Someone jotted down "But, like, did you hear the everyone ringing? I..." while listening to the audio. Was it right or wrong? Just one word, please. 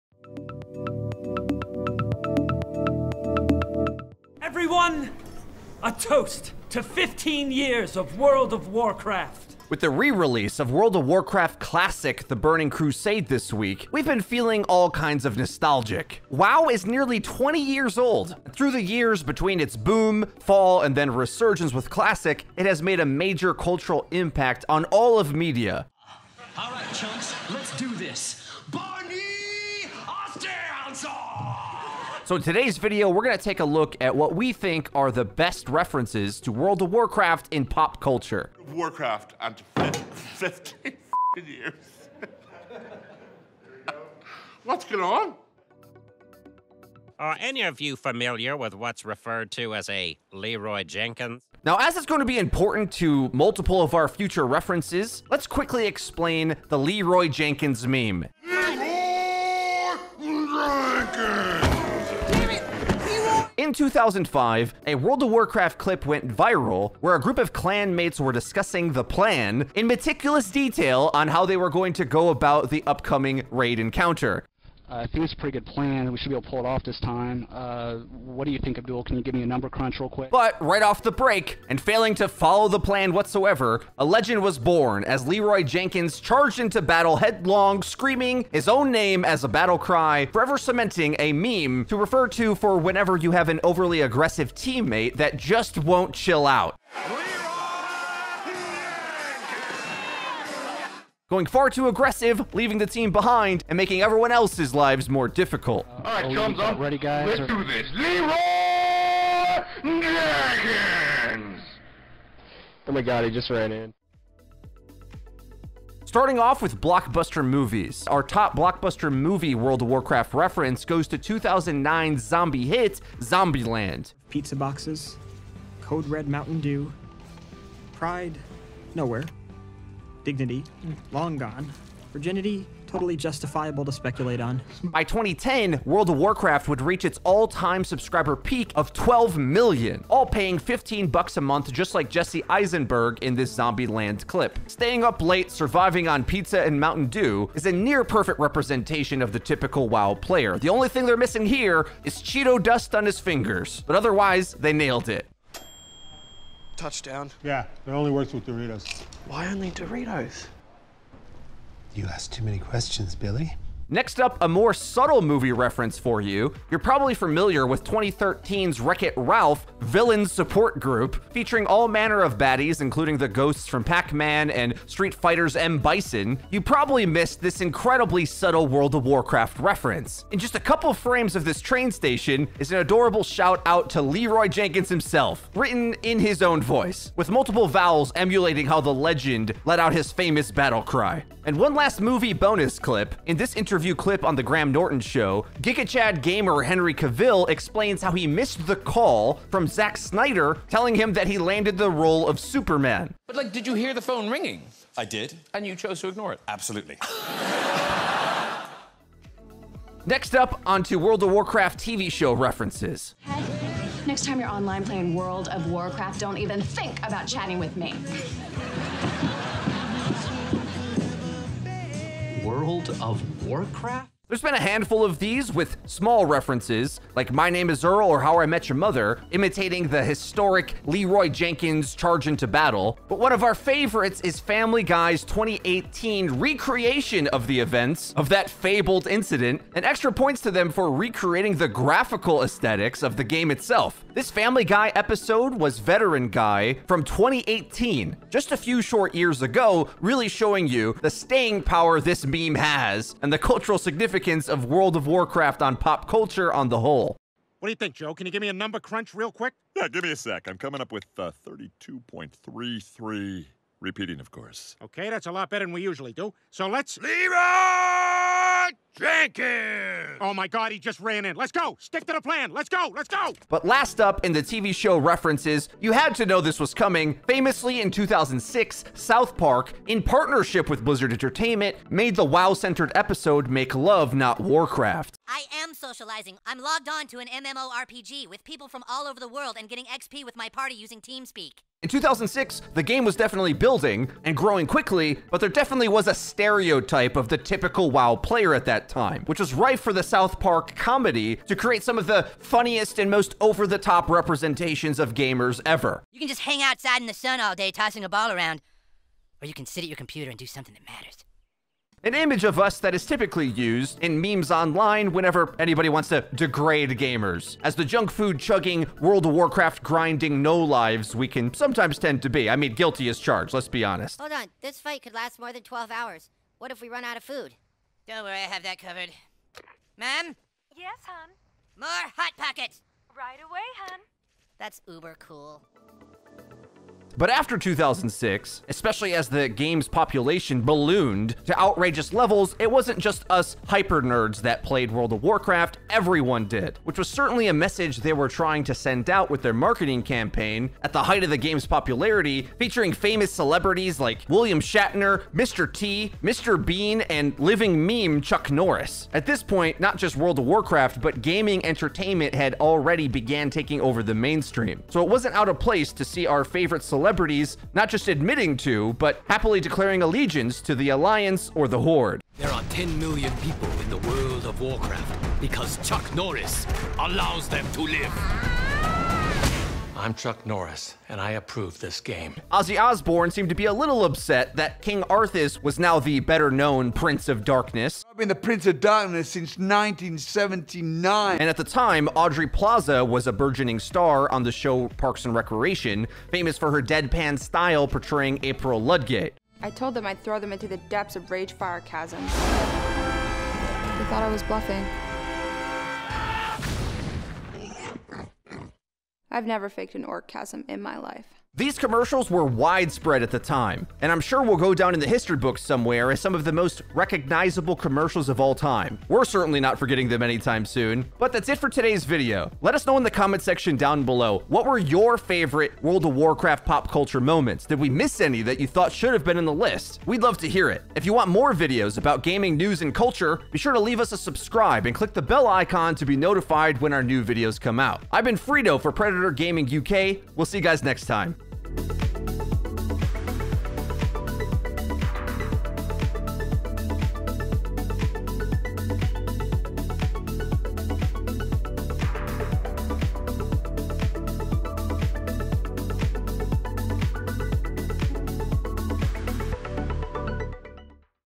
wrong.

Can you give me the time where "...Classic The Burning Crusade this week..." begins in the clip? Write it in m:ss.
0:11.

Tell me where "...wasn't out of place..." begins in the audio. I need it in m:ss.
6:05.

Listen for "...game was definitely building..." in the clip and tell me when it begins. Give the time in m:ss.
4:52.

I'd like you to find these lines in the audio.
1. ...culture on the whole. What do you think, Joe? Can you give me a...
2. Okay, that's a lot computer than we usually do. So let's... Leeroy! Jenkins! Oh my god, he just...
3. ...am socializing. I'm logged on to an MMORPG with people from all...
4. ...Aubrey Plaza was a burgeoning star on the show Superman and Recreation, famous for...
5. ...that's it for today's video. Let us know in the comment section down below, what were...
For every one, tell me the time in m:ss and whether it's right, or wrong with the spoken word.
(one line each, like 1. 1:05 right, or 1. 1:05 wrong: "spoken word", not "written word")
1. 4:16 right
2. 4:24 wrong: "better", not "computer"
3. 4:45 right
4. 6:32 wrong: "Parks", not "Superman"
5. 7:01 right.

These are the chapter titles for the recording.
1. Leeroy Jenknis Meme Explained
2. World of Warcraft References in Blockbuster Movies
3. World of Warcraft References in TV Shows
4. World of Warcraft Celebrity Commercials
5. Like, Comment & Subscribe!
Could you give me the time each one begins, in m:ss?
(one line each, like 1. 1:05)
1. 0:46
2. 1:55
3. 3:29
4. 5:36
5. 7:02.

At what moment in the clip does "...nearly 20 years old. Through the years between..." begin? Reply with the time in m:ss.
0:16.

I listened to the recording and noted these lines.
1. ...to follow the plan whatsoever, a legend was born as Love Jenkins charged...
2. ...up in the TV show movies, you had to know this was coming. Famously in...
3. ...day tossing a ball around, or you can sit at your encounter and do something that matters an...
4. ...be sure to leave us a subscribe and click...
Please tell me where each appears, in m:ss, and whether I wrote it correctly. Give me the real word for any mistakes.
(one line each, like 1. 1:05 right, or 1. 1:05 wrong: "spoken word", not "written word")
1. 1:22 wrong: "Leeroy", not "Love"
2. 4:34 wrong: "references", not "movies"
3. 5:07 wrong: "computer", not "encounter"
4. 7:13 right.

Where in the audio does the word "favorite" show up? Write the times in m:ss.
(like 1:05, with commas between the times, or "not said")
3:53, 6:06, 7:05.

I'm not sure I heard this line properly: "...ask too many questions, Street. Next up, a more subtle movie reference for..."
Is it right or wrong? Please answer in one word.
wrong.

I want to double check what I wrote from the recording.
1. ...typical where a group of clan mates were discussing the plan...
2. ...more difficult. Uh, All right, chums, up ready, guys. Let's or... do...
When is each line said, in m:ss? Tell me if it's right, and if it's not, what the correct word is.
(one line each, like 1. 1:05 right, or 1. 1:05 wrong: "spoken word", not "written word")
1. 1:06 wrong: "viral", not "typical"
2. 1:45 right.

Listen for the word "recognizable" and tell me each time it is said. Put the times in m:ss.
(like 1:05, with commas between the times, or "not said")
6:56.